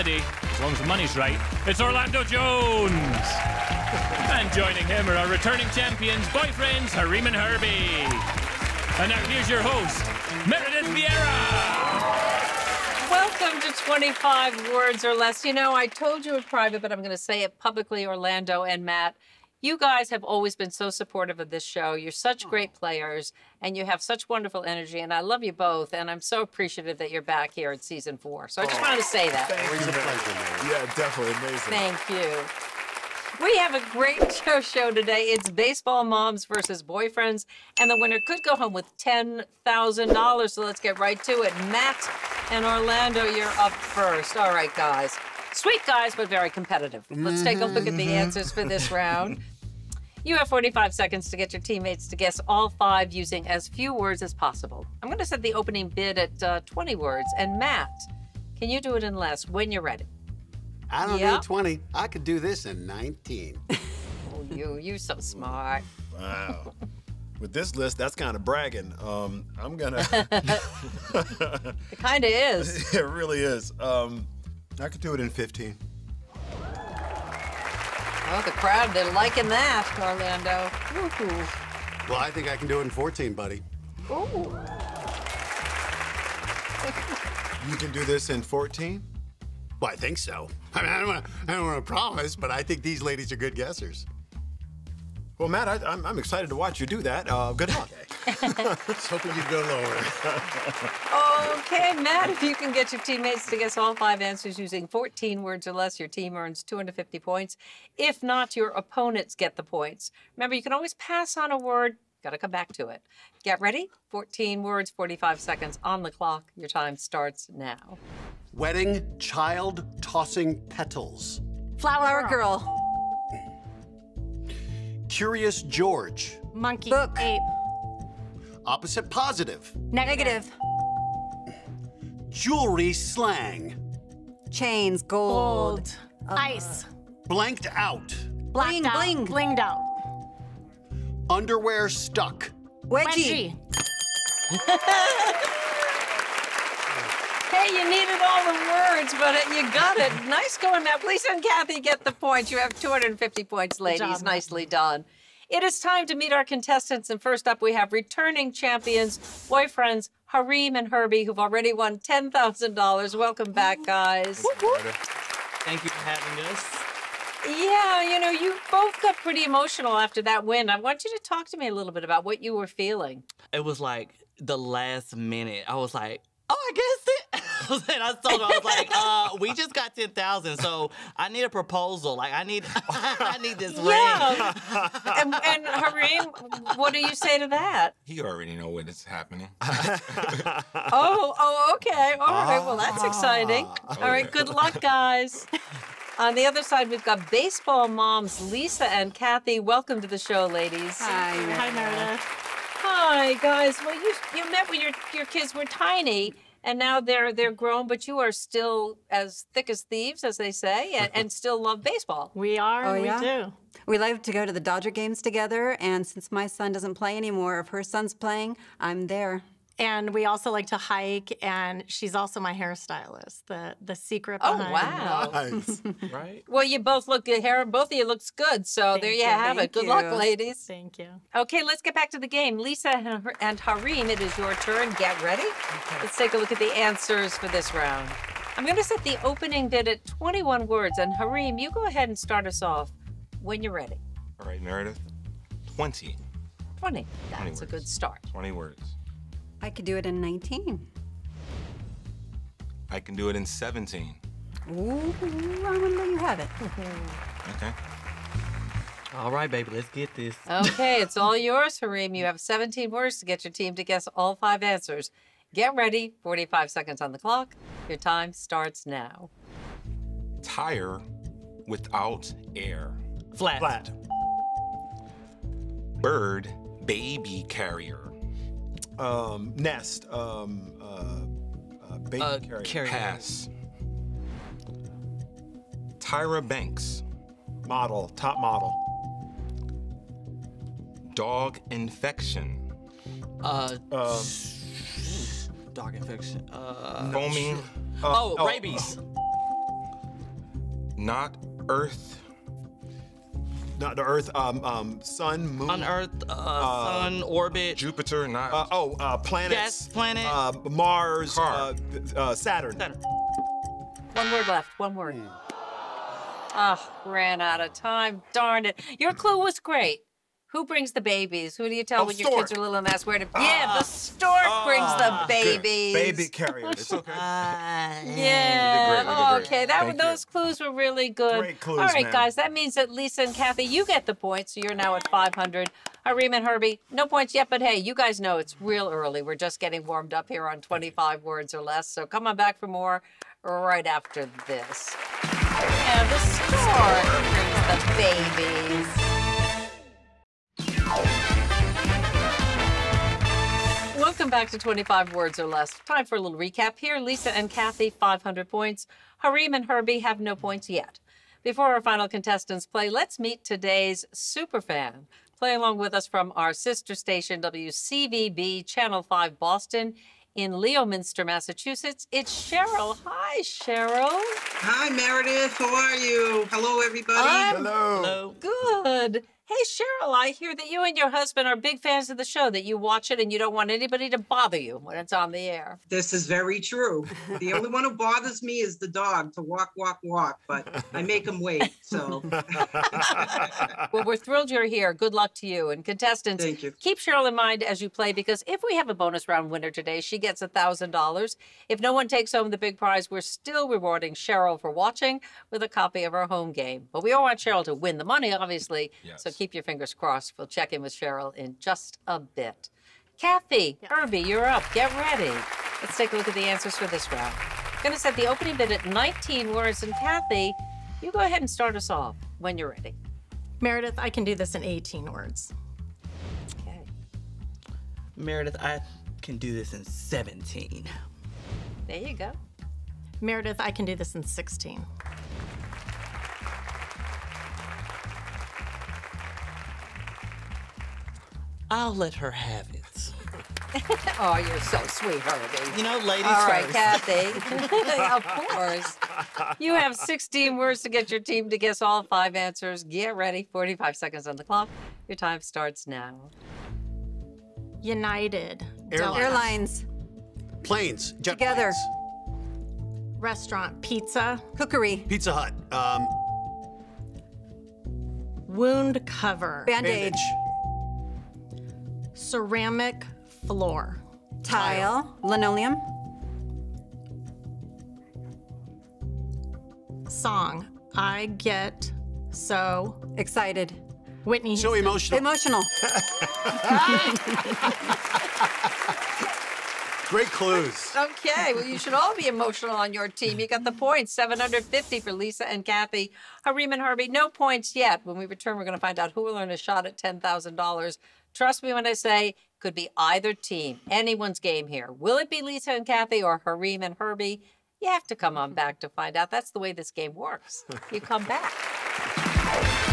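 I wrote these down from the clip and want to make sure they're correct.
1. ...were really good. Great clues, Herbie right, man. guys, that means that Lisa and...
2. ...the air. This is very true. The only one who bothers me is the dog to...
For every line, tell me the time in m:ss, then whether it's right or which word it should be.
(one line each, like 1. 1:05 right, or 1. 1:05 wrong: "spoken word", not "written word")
1. 5:30 wrong: "All", not "Herbie"
2. 6:25 right.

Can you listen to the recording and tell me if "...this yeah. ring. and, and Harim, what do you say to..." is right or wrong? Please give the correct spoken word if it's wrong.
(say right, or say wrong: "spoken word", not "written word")
right.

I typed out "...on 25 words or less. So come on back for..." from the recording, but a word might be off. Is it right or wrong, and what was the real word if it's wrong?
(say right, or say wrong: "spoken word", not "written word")
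right.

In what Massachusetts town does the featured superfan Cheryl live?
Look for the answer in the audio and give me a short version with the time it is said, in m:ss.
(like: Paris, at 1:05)
Leominster, at 6:10.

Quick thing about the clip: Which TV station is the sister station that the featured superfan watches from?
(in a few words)
WCVB.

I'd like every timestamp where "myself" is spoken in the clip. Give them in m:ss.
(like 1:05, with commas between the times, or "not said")
not said.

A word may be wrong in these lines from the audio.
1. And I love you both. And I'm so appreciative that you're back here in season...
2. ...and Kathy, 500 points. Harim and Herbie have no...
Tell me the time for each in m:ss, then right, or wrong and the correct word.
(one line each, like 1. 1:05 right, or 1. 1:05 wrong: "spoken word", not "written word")
1. 0:25 right
2. 5:57 right.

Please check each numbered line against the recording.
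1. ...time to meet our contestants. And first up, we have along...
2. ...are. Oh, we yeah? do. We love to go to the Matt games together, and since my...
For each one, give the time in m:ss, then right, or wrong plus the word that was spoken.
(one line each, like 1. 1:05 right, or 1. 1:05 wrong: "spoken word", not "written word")
1. 2:35 wrong: "returning", not "along"
2. 3:32 wrong: "Dodger", not "Matt".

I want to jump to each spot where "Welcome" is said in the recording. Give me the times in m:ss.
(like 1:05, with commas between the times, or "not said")
2:43, 3:19, 5:54.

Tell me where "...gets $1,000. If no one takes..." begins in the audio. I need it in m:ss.
6:40.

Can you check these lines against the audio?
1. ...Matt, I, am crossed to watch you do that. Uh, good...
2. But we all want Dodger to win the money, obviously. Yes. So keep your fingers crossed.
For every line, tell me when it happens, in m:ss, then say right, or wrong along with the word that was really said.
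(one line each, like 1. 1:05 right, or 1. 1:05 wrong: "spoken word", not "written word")
1. 1:35 wrong: "excited", not "crossed"
2. 6:46 wrong: "Cheryl", not "Dodger".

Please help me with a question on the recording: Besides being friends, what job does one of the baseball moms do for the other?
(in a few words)
Hairstylist.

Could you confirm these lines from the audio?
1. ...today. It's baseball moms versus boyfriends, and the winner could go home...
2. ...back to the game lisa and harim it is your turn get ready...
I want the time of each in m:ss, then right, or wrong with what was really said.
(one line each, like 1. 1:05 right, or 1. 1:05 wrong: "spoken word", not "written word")
1. 0:34 right
2. 3:51 right.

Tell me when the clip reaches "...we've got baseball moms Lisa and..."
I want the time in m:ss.
3:16.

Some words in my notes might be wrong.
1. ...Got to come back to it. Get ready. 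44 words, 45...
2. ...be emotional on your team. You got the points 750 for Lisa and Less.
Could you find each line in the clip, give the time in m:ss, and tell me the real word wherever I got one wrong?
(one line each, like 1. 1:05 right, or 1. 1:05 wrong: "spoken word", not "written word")
1. 1:52 wrong: "14", not "44"
2. 8:12 wrong: "Kathy", not "Less".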